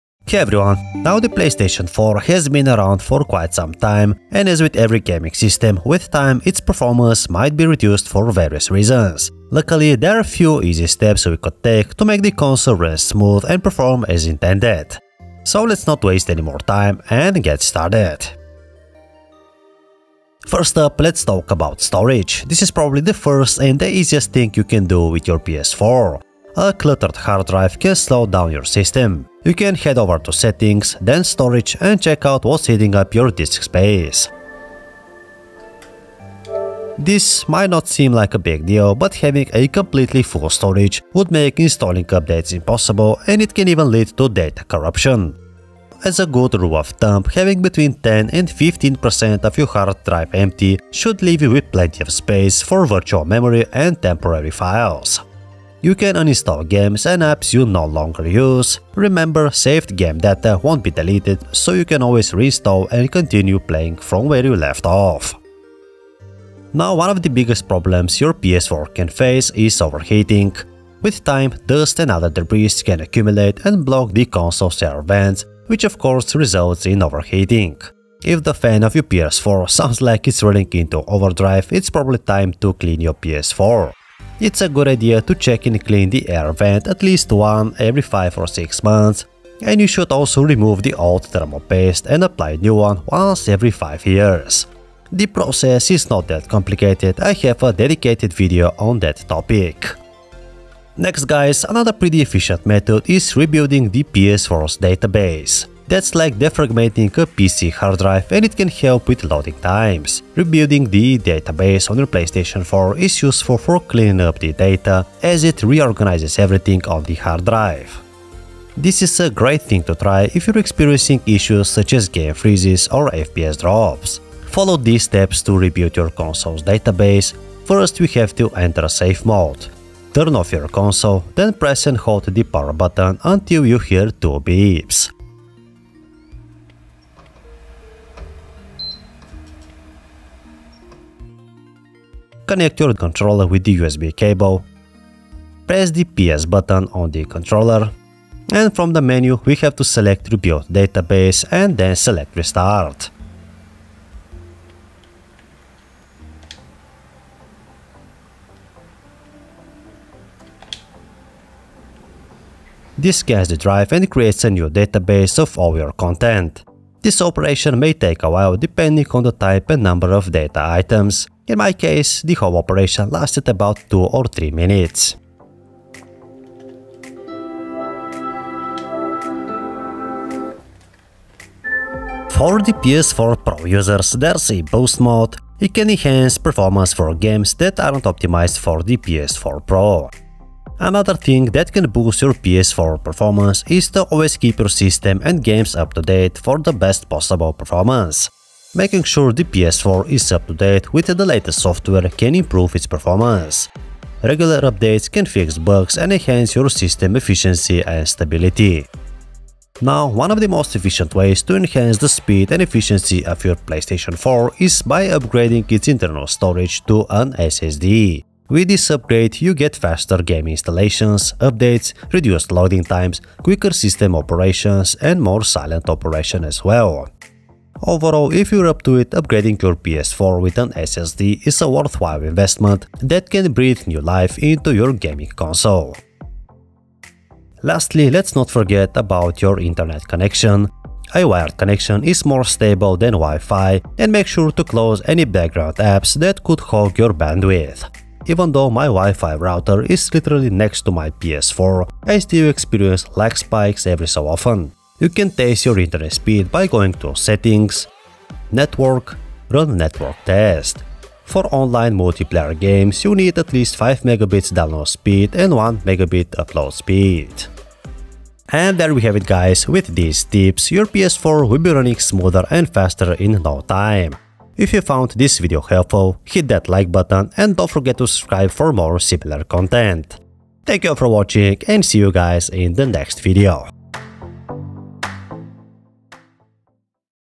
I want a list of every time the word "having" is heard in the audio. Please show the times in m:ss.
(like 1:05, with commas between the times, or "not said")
0:39, 0:47.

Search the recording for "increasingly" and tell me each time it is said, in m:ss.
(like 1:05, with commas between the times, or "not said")
not said.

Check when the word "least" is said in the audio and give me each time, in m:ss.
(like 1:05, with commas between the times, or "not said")
1:27, 4:23.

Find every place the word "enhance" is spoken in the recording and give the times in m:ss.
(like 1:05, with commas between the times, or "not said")
3:05, 3:26, 3:31.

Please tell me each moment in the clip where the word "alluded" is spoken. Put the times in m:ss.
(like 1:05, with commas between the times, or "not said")
not said.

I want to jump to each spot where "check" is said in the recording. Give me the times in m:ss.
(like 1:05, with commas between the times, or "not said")
0:32, 1:25.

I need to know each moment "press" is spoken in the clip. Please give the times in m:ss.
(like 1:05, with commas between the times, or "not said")
2:11, 2:25.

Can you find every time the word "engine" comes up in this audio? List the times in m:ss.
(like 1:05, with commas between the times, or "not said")
not said.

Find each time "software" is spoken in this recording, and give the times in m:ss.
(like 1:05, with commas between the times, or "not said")
3:21.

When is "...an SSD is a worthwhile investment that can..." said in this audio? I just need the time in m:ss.
3:50.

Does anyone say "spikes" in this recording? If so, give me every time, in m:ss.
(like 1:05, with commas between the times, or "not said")
4:13.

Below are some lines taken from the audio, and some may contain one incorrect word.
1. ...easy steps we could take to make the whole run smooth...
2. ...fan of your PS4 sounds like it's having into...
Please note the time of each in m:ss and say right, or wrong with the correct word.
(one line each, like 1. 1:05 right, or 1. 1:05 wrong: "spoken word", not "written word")
1. 0:10 wrong: "console", not "whole"
2. 1:18 wrong: "running", not "having".